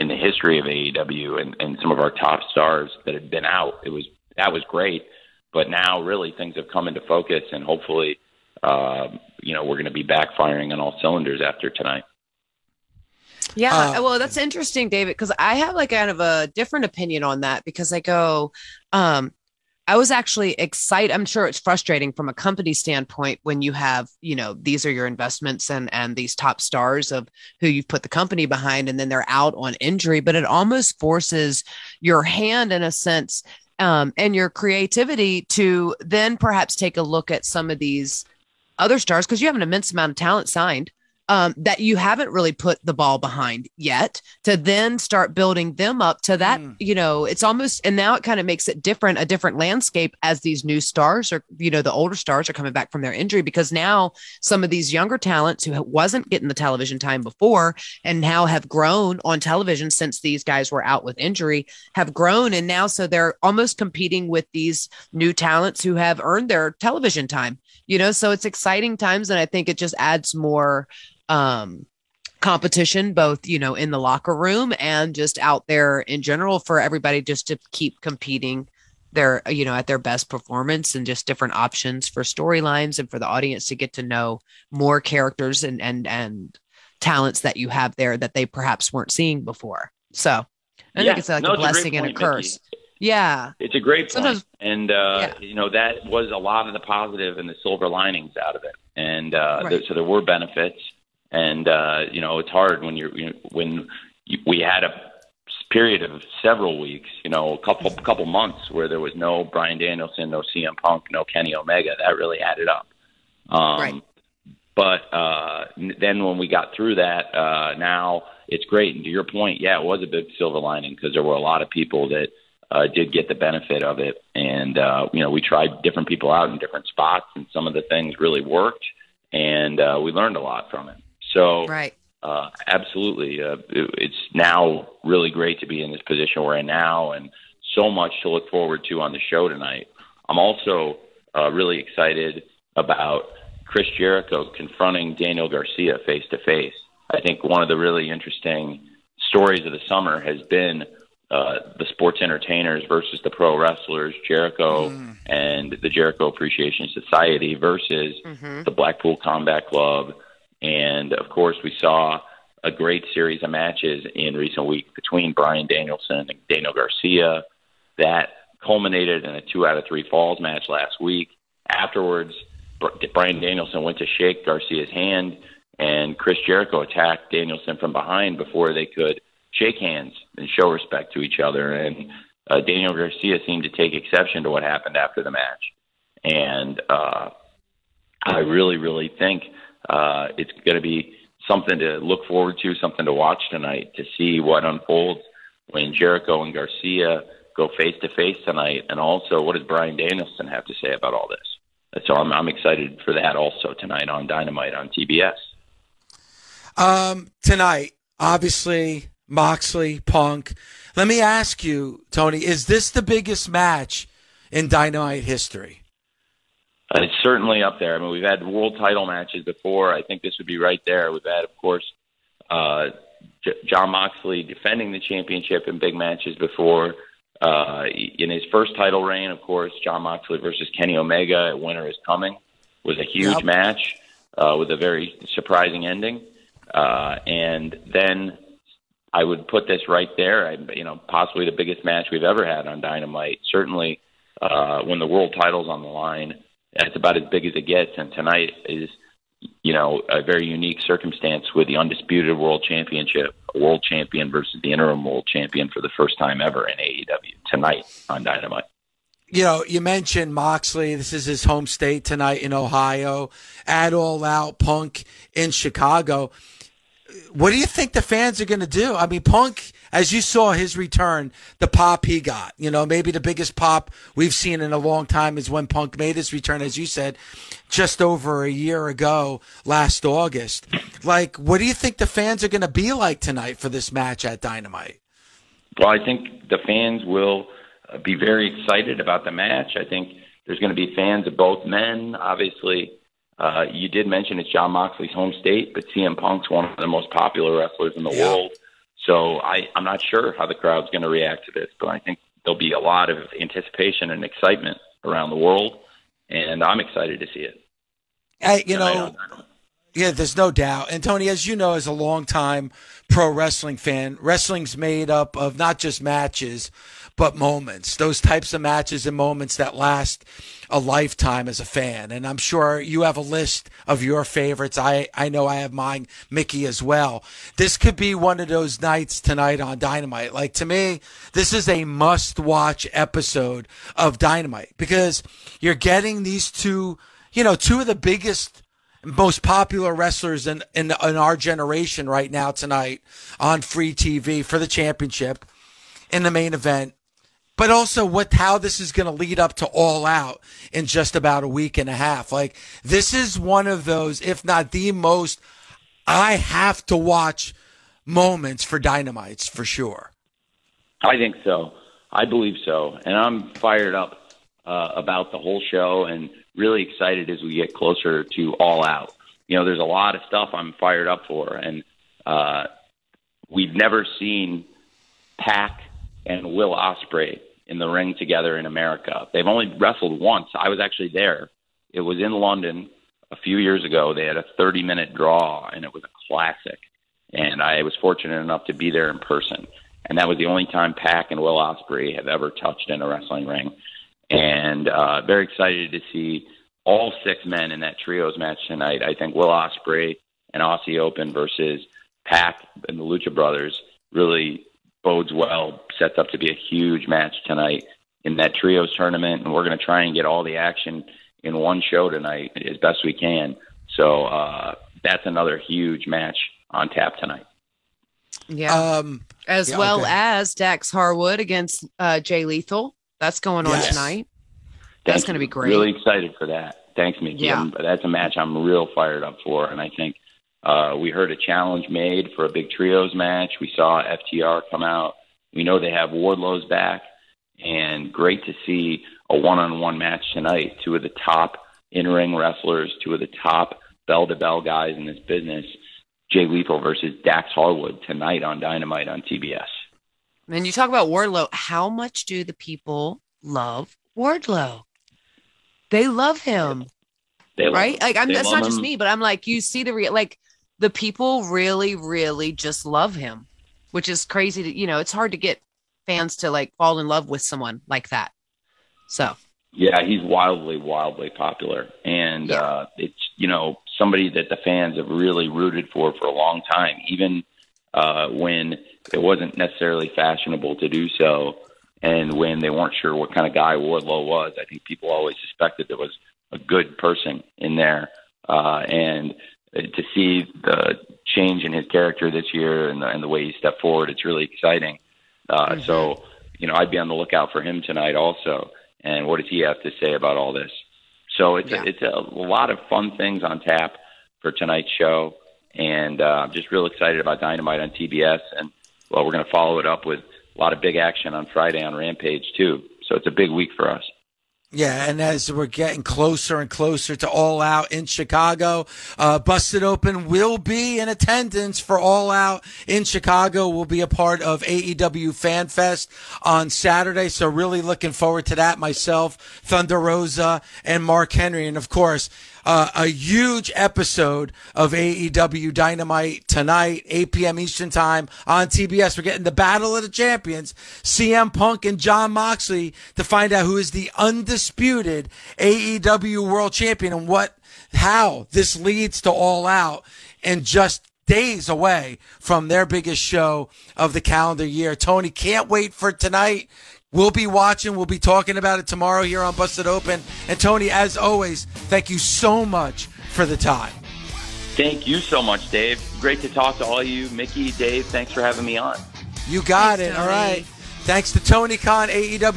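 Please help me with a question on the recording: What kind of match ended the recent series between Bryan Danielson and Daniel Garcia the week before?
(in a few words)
Two out of three falls.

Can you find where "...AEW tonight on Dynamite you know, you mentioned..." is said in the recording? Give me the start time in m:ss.
4:16.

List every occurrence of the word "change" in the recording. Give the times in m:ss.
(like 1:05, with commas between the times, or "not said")
8:11.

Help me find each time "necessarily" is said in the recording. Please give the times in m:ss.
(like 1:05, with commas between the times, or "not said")
7:59.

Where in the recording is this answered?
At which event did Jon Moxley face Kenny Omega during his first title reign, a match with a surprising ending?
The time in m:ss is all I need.
3:51.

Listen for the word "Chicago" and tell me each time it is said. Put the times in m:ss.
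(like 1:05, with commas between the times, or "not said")
4:25, 8:38, 8:43.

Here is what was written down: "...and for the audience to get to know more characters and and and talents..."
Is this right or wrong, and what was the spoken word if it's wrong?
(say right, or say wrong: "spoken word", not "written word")
right.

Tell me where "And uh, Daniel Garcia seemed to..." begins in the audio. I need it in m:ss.
3:01.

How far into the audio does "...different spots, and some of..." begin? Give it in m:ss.
2:06.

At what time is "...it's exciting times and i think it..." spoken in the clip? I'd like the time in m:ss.
1:08.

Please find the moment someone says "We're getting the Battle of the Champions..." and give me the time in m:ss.
8:59.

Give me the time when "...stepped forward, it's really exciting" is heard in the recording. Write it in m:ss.
8:13.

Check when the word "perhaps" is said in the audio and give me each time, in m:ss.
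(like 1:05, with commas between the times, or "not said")
0:36, 1:28.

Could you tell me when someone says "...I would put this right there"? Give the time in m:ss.
3:59.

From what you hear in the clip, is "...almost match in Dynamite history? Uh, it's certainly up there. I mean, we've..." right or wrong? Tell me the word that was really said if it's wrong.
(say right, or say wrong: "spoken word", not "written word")
wrong: "biggest", not "almost".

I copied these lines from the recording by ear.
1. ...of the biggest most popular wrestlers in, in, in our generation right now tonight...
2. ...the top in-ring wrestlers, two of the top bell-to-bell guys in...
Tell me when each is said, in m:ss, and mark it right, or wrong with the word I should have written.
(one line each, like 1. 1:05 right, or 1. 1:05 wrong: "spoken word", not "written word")
1. 5:37 right
2. 7:21 right.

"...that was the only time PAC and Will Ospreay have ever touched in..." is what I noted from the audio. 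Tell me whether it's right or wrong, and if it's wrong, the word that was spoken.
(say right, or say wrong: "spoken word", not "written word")
right.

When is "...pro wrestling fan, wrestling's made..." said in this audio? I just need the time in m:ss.
5:13.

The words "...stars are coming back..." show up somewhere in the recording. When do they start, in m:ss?
0:52.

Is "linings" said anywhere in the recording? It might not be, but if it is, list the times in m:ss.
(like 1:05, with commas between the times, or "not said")
1:37, 2:00.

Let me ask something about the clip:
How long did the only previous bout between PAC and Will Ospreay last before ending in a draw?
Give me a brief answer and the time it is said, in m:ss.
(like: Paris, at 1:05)
30 minutes, at 6:24.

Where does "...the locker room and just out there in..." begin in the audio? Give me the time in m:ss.
1:13.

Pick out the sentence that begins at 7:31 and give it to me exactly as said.
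How much do the people love Wardlow?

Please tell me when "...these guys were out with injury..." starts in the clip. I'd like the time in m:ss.
1:00.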